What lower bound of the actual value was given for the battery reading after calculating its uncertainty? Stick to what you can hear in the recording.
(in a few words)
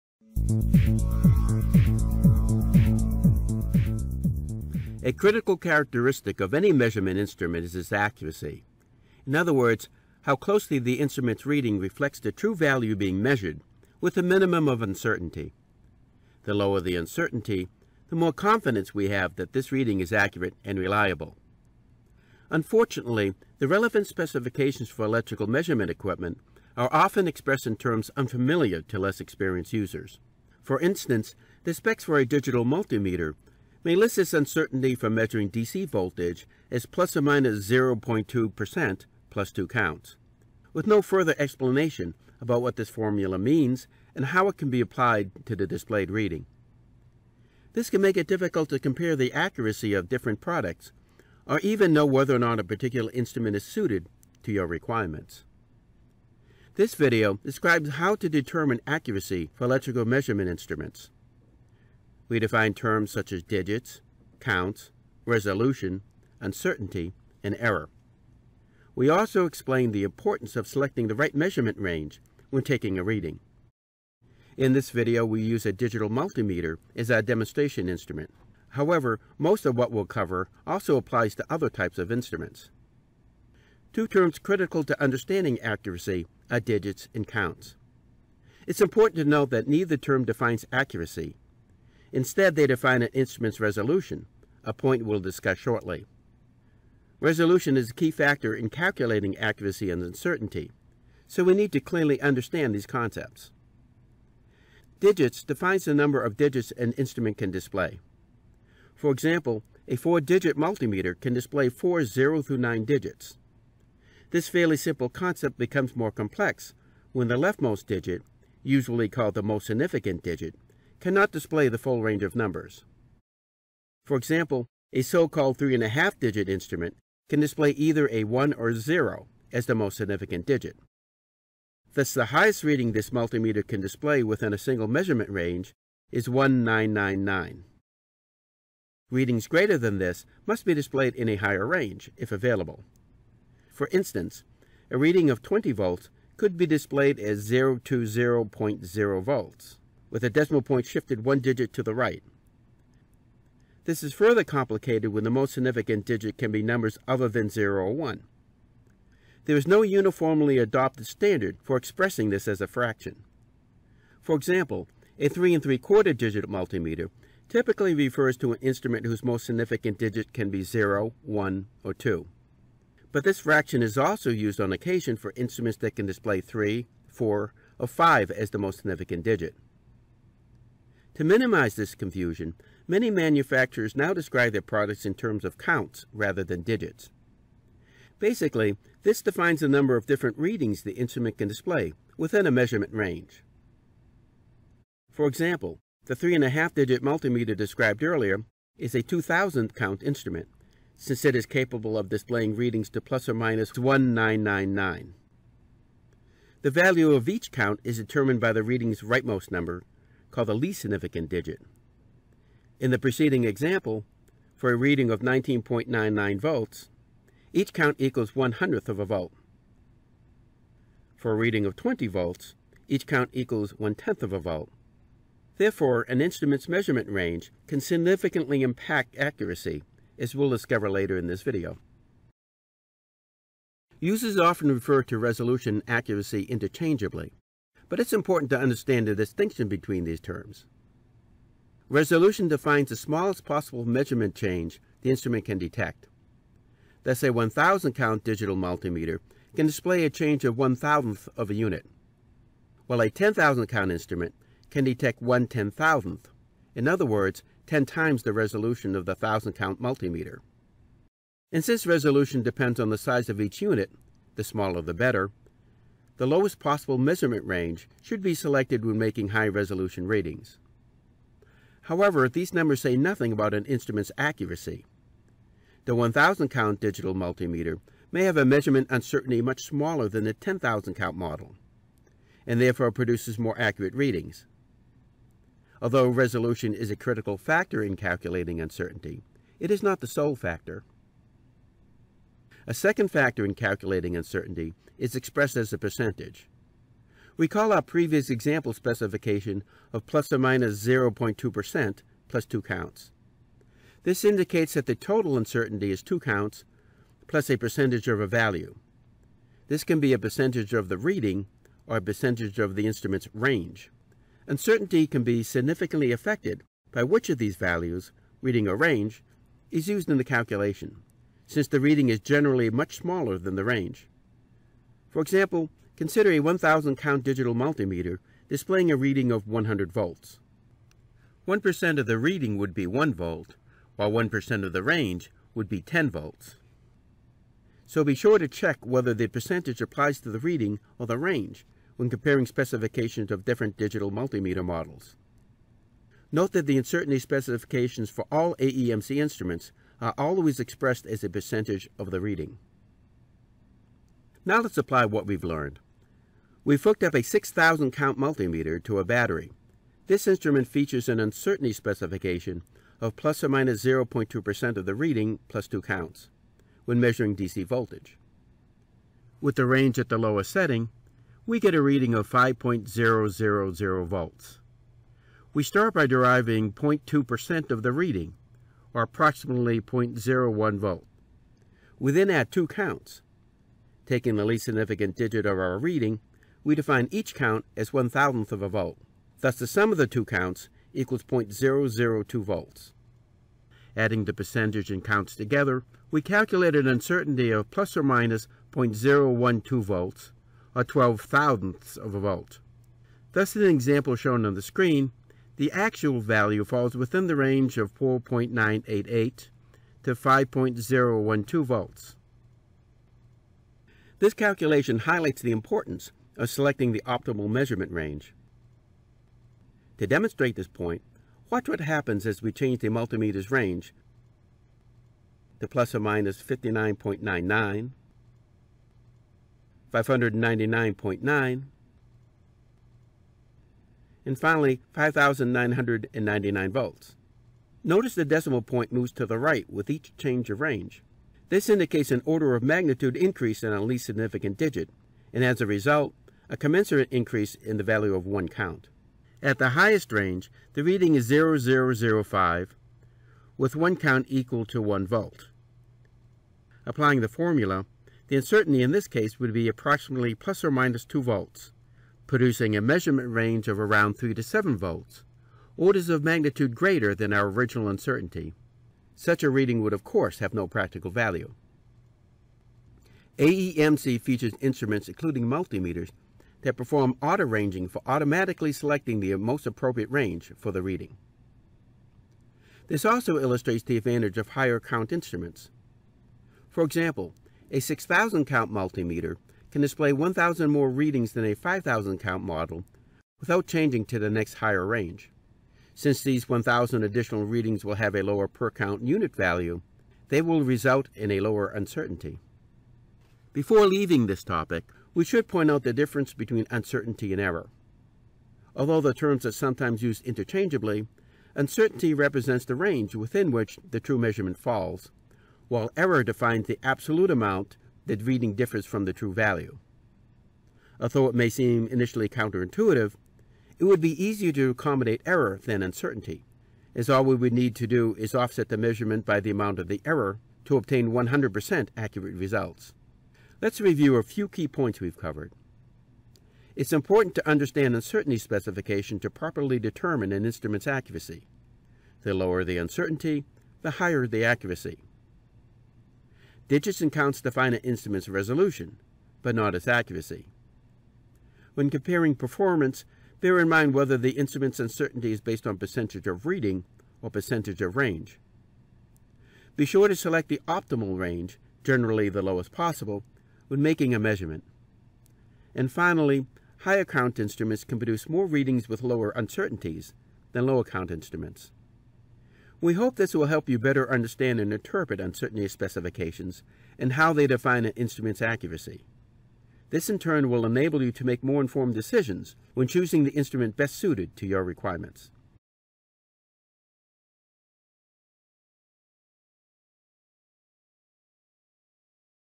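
4.988 volts.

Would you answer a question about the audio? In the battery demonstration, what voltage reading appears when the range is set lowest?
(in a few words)
5.000 volts.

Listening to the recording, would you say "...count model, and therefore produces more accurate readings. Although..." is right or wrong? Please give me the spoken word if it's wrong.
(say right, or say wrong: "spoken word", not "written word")
right.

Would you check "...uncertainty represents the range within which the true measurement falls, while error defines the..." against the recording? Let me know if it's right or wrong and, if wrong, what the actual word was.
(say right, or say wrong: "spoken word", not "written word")
right.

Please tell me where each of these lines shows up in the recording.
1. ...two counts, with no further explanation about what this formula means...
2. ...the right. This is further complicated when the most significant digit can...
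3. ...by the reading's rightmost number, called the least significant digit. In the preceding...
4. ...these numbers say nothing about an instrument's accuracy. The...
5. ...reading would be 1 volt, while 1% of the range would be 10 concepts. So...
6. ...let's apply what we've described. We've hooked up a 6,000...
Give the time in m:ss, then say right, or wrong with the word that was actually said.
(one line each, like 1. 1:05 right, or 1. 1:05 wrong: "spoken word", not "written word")
1. 0:39 right
2. 2:31 right
3. 3:28 right
4. 4:32 right
5. 5:32 wrong: "volts", not "concepts"
6. 5:54 wrong: "learned", not "described".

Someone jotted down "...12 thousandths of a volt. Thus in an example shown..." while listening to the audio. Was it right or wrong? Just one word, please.
right.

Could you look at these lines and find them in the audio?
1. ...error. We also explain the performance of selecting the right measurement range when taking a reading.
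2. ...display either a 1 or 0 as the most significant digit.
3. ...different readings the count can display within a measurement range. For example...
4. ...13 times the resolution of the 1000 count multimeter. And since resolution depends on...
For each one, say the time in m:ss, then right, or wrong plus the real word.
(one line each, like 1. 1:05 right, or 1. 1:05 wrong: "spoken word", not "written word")
1. 1:07 wrong: "importance", not "performance"
2. 2:07 right
3. 3:10 wrong: "instrument", not "count"
4. 4:17 wrong: "10", not "13".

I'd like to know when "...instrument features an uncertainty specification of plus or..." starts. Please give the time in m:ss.
6:00.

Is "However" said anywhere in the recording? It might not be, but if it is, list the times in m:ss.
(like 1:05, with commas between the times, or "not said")
1:18, 4:31.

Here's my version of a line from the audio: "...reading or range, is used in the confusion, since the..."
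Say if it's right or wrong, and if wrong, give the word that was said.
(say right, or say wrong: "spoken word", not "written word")
wrong: "calculation", not "confusion".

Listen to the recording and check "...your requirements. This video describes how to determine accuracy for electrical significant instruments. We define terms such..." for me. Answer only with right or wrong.
wrong.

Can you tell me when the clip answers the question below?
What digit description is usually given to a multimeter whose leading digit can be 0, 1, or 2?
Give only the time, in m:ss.
2:45.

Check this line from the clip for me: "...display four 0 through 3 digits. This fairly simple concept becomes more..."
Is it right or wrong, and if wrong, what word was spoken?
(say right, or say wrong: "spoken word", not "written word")
wrong: "9", not "3".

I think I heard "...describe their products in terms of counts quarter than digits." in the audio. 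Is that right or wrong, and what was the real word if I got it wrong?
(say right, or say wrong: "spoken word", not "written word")
wrong: "rather", not "quarter".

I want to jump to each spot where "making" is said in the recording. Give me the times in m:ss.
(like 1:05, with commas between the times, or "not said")
4:28, 9:23.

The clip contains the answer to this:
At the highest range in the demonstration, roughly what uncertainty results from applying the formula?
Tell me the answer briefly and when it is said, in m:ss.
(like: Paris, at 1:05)
2 volts, at 7:41.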